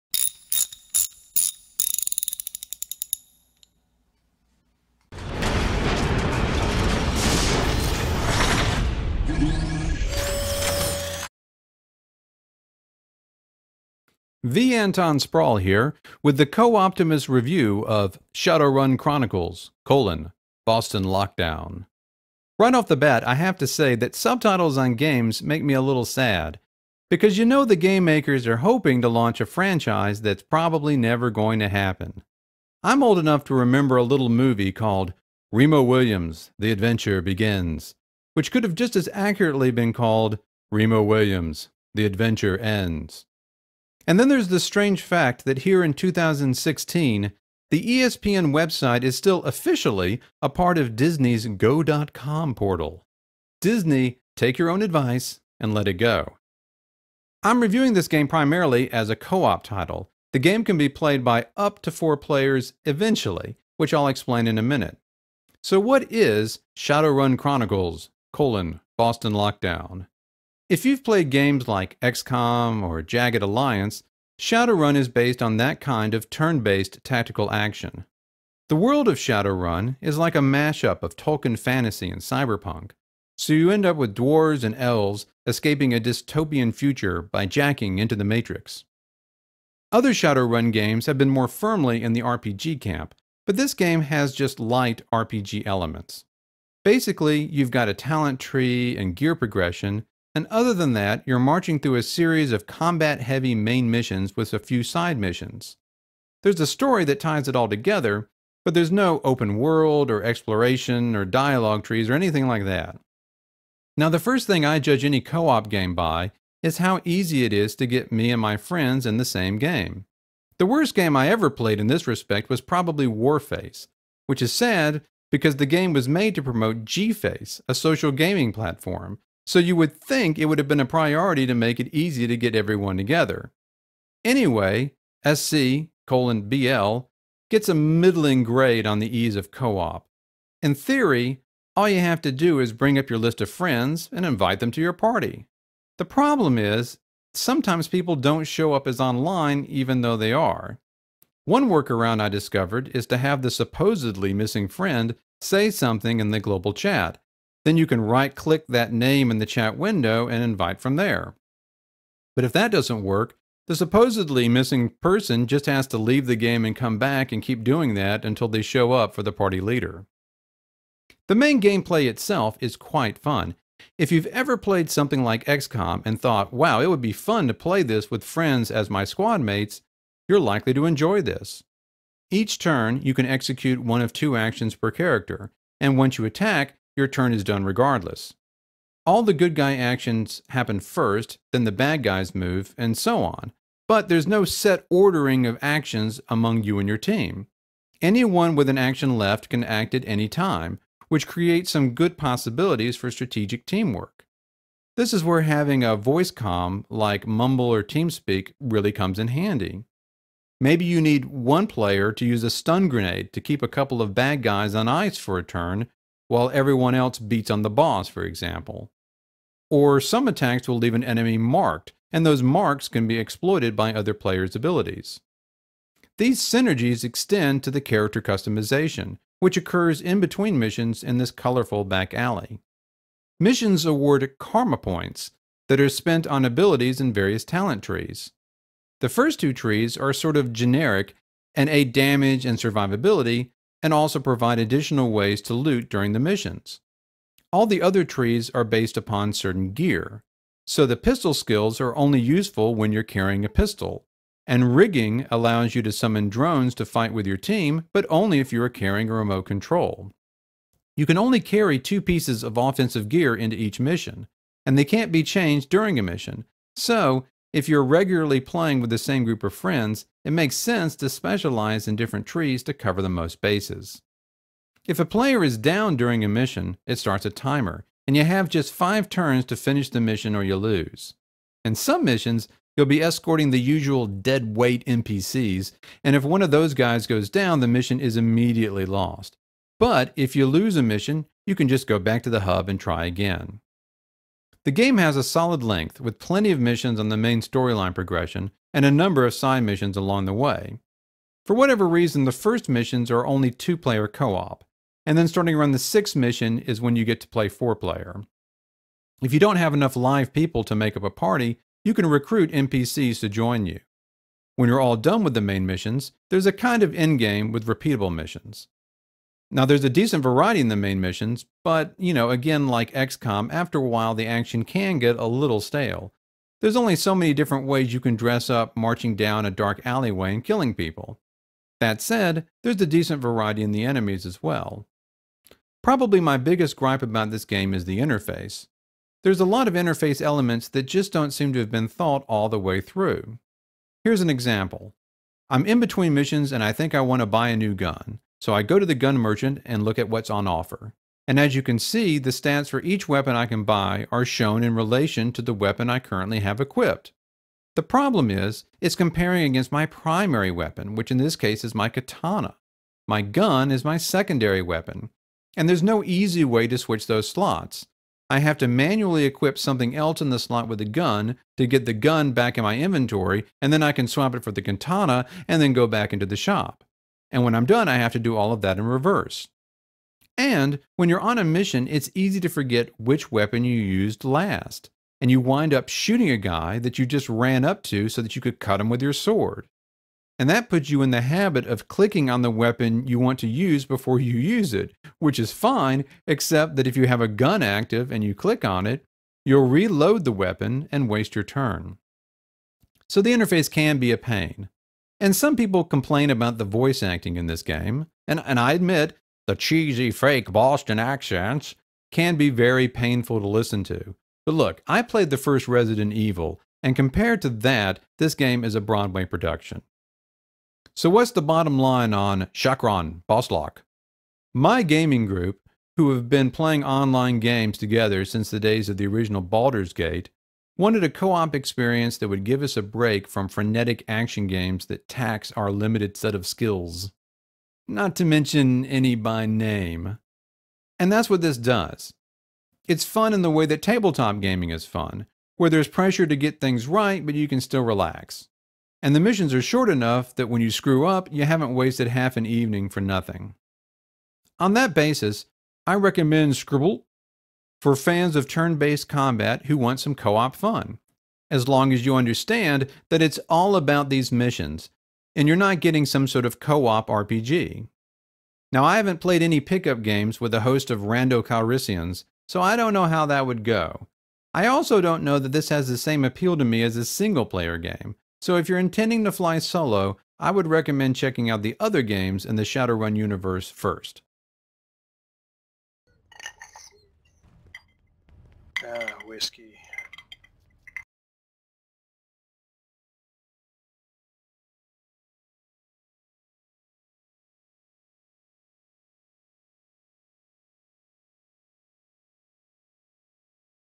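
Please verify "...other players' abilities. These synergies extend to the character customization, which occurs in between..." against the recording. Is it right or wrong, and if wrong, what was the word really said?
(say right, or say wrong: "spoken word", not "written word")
right.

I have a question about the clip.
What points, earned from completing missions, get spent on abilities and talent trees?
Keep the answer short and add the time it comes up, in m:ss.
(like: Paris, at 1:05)
karma points, at 3:54.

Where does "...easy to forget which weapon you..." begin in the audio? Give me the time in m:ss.
6:22.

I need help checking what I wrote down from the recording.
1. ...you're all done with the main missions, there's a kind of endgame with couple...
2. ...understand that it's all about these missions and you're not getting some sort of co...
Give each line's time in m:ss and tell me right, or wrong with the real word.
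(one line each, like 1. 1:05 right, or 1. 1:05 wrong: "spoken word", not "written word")
1. 5:14 wrong: "repeatable", not "couple"
2. 7:42 right.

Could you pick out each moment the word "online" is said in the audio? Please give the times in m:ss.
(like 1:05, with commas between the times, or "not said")
2:28, 7:06.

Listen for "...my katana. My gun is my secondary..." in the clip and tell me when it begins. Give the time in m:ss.
6:01.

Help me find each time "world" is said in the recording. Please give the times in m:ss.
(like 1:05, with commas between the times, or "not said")
1:18, 1:49.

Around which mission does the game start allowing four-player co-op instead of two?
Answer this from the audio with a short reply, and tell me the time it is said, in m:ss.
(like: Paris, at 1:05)
the sixth mission, at 5:05.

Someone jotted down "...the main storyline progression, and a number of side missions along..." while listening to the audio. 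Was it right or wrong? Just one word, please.
right.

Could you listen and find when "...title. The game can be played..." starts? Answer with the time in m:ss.
0:59.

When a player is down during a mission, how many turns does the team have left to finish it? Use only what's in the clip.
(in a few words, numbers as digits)
5.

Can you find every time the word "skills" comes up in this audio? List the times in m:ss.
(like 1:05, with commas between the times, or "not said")
4:11, 7:16.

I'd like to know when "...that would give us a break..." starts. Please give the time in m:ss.
7:12.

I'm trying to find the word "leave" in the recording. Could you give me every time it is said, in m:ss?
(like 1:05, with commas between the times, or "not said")
2:45, 3:40.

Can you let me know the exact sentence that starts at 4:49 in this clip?
But if you lose a mission, you can just go back to the hub and try again.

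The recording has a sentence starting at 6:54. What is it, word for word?
But look, I played the first Resident Evil, and compared to that, this game is a Broadway production.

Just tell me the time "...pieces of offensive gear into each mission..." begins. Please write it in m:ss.
4:22.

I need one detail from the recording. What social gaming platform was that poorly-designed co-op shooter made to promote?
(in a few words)
Gface.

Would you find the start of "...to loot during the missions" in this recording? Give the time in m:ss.
4:05.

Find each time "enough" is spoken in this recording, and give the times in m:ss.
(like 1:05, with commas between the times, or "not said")
0:33, 5:09, 7:29.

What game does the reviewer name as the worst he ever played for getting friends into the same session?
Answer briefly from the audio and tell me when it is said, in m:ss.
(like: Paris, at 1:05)
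Warface, at 2:03.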